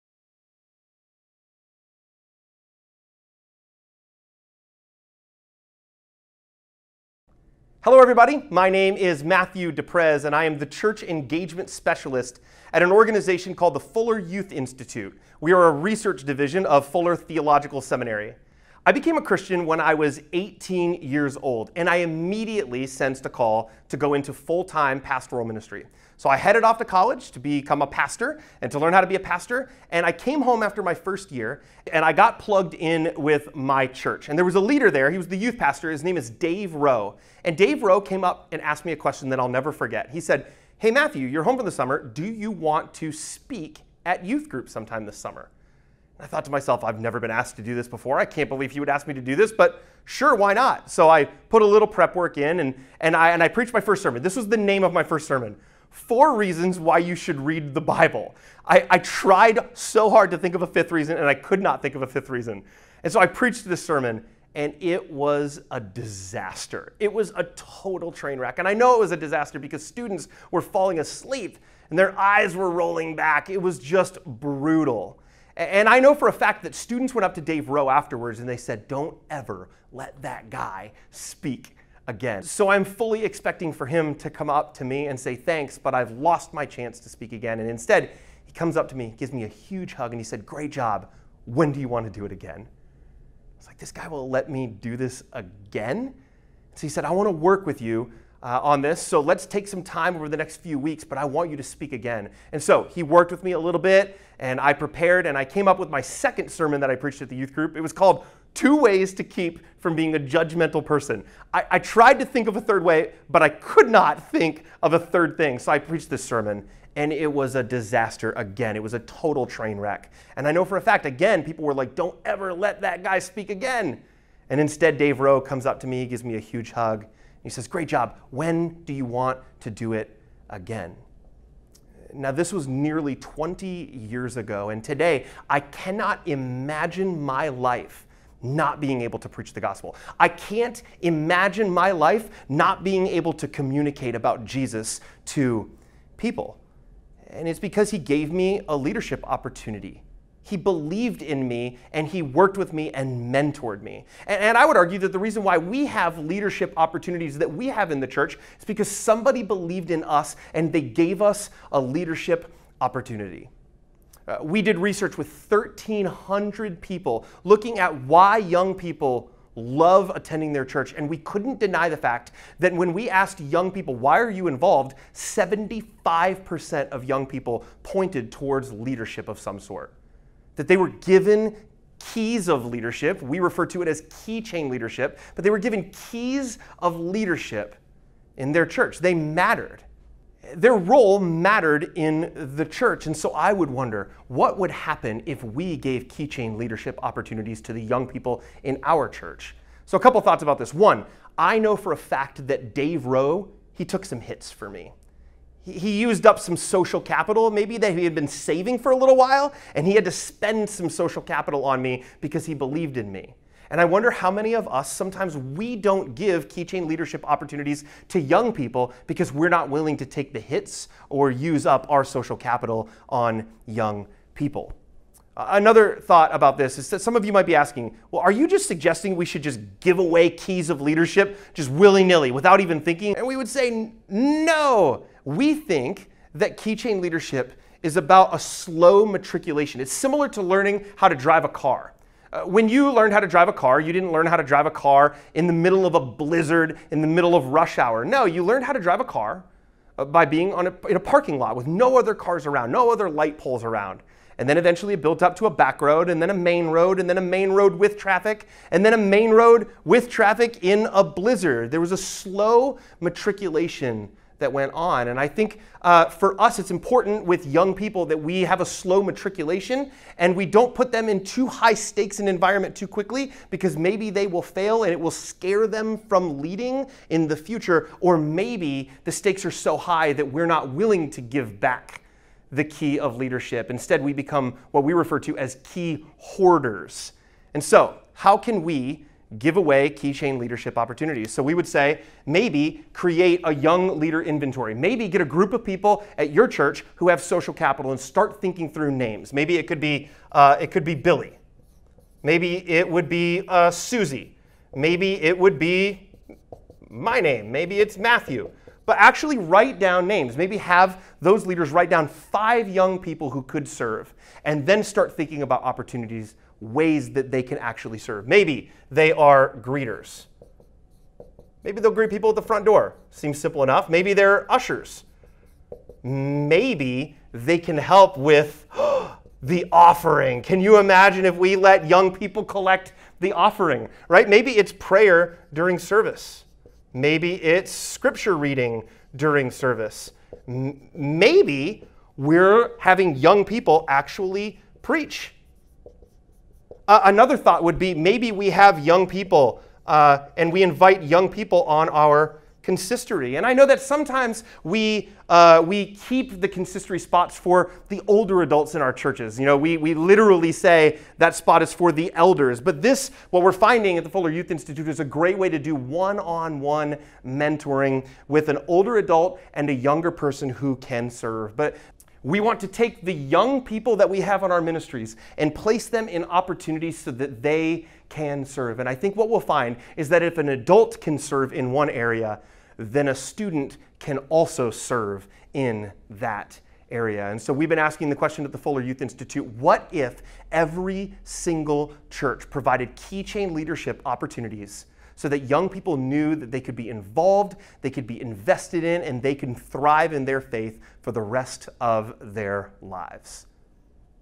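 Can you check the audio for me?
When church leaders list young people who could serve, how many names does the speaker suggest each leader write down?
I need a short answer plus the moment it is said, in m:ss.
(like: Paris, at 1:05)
5, at 5:12.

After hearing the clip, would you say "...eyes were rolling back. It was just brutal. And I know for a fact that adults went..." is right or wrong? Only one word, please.
wrong.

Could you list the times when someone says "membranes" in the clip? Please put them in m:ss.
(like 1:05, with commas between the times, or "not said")
not said.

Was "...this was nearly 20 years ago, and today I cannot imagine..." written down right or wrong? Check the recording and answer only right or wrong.
right.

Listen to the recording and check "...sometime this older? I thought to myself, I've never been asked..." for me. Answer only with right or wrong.
wrong.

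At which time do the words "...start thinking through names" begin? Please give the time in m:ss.
4:57.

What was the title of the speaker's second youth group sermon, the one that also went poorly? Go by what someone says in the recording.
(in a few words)
Two Ways to Keep from Being a Judgmental Person.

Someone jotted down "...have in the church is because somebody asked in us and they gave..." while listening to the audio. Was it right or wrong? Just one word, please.
wrong.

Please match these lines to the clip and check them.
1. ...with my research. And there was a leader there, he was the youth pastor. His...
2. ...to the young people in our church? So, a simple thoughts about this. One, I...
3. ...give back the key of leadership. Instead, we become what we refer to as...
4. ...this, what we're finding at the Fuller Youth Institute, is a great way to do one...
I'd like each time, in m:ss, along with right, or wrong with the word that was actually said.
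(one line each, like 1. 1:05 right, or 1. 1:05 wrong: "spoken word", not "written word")
1. 0:33 wrong: "church", not "research"
2. 3:17 wrong: "couple", not "simple"
3. 4:41 right
4. 6:02 right.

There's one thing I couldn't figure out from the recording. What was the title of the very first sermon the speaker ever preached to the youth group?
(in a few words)
Four Reasons Why You Should Read the Bible.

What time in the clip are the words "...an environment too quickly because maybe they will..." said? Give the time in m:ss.
4:32.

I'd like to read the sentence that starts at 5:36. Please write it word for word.
Maybe it's scripture reading during service.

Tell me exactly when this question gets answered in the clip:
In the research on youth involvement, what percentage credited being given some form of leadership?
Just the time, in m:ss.
2:55.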